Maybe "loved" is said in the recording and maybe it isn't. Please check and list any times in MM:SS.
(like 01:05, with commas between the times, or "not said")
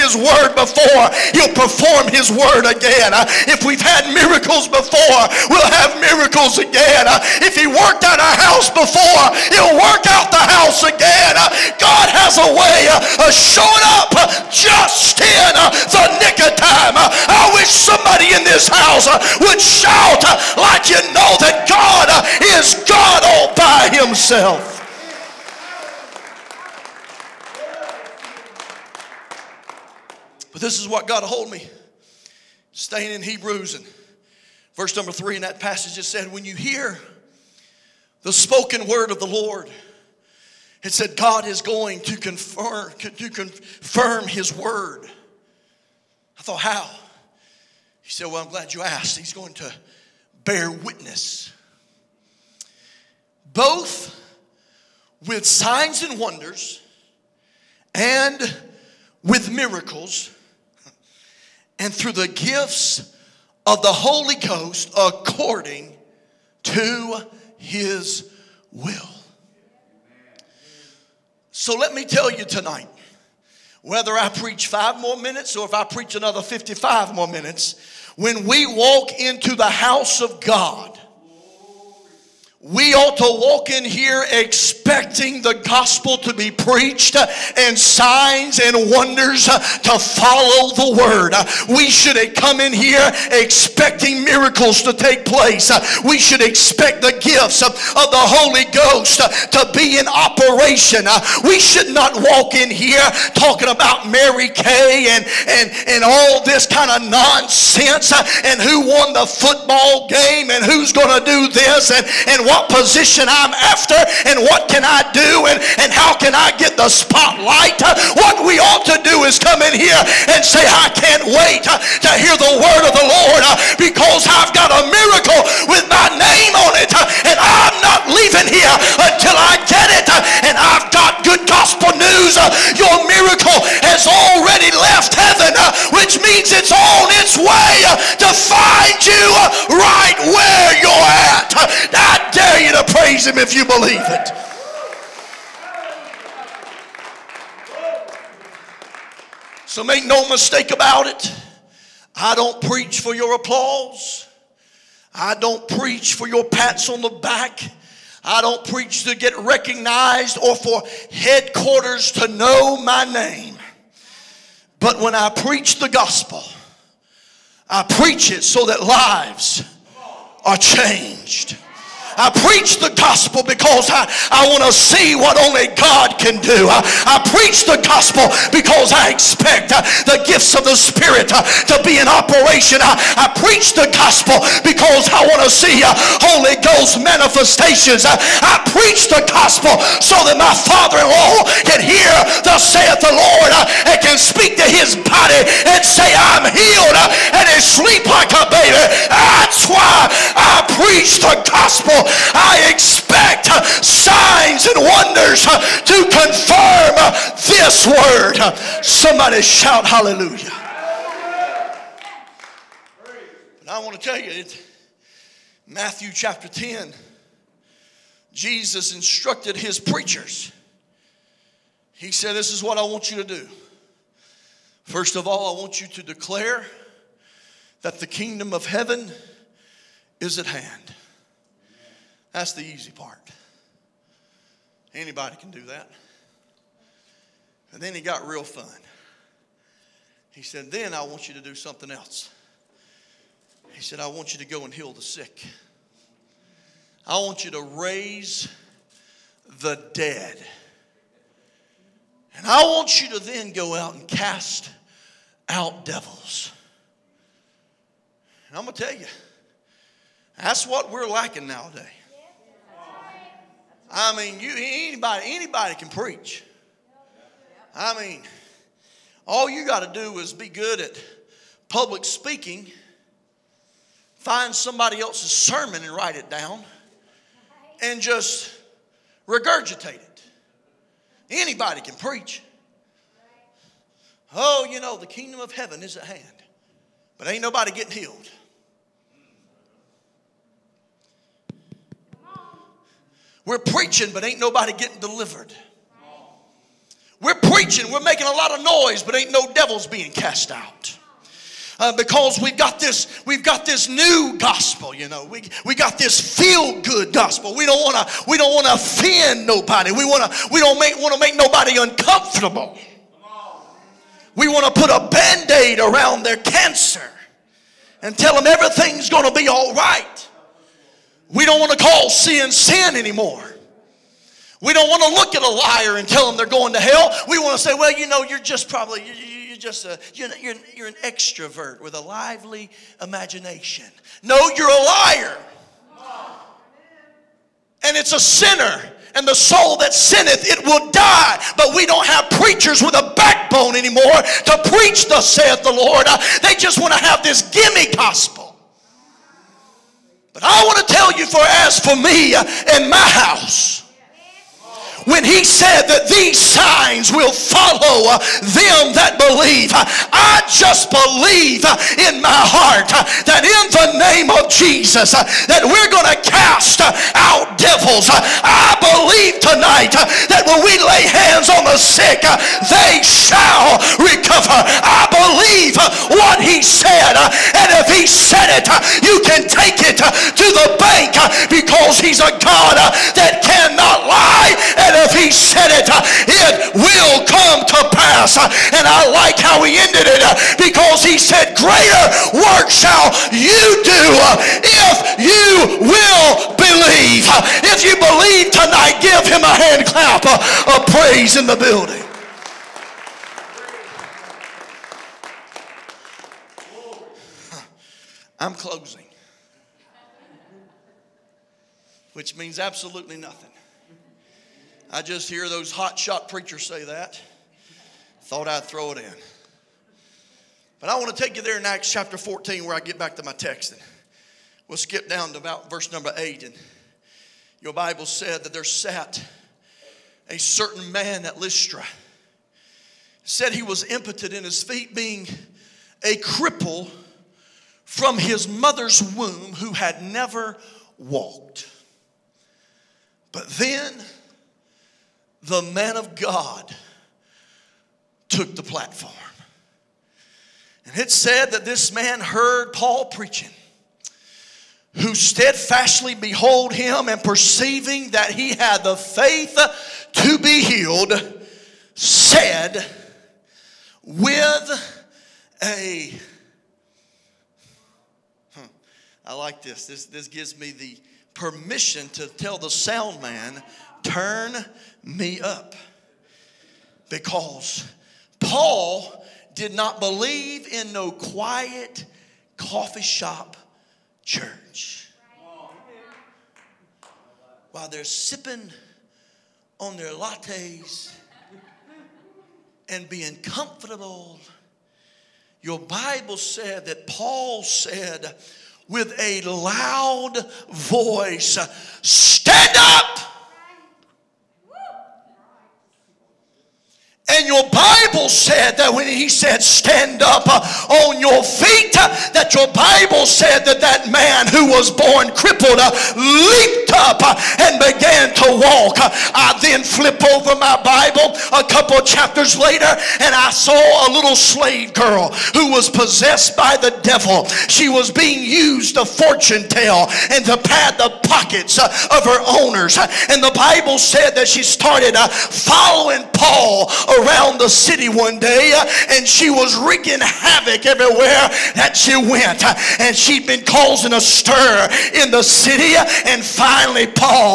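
not said.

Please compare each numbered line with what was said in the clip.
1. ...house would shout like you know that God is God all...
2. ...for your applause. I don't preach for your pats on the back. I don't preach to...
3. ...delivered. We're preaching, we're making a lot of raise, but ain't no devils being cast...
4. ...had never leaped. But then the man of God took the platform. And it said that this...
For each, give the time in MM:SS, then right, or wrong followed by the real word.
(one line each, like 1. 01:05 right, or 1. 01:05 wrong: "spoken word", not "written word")
1. 00:18 right
2. 02:33 right
3. 04:54 wrong: "noise", not "raise"
4. 07:19 wrong: "walked", not "leaped".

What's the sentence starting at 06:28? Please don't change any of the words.
And I like how he ended it because he said, Greater work shall you do if you will believe.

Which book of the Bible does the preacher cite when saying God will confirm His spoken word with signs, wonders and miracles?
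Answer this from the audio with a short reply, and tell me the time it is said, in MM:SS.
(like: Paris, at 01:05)
Hebrews, at 00:33.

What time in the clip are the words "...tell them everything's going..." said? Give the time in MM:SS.
05:18.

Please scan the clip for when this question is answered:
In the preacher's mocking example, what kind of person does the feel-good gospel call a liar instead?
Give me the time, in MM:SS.
05:30.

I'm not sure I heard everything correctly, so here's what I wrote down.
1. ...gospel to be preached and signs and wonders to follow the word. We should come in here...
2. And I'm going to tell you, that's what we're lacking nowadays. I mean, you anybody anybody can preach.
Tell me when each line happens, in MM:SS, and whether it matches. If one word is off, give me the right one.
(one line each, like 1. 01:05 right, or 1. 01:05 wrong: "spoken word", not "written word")
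1. 01:25 right
2. 04:18 right.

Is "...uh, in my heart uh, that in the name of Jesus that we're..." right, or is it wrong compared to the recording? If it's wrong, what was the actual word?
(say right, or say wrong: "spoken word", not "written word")
right.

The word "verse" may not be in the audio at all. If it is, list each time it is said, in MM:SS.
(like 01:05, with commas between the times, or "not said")
00:34, 07:05.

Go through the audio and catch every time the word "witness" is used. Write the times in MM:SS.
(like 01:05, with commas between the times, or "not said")
00:50.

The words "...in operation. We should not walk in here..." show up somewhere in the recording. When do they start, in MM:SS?
01:40.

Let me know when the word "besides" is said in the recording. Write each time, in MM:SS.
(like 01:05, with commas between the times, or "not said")
not said.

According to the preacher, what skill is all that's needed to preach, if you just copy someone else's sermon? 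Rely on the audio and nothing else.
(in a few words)
public speaking.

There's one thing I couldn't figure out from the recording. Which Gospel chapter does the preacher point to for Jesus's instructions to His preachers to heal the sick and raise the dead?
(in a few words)
Matthew chapter 10.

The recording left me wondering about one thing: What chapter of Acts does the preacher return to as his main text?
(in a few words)
Acts chapter 14.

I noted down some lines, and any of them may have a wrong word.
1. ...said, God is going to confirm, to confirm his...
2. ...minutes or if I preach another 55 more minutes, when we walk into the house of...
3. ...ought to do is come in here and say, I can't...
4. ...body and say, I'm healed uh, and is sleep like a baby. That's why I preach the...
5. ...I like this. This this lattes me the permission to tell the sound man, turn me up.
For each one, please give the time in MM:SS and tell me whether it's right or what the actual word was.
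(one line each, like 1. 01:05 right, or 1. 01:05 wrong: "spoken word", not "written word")
1. 00:40 right
2. 01:15 right
3. 01:58 right
4. 03:15 right
5. 07:49 wrong: "gives", not "lattes".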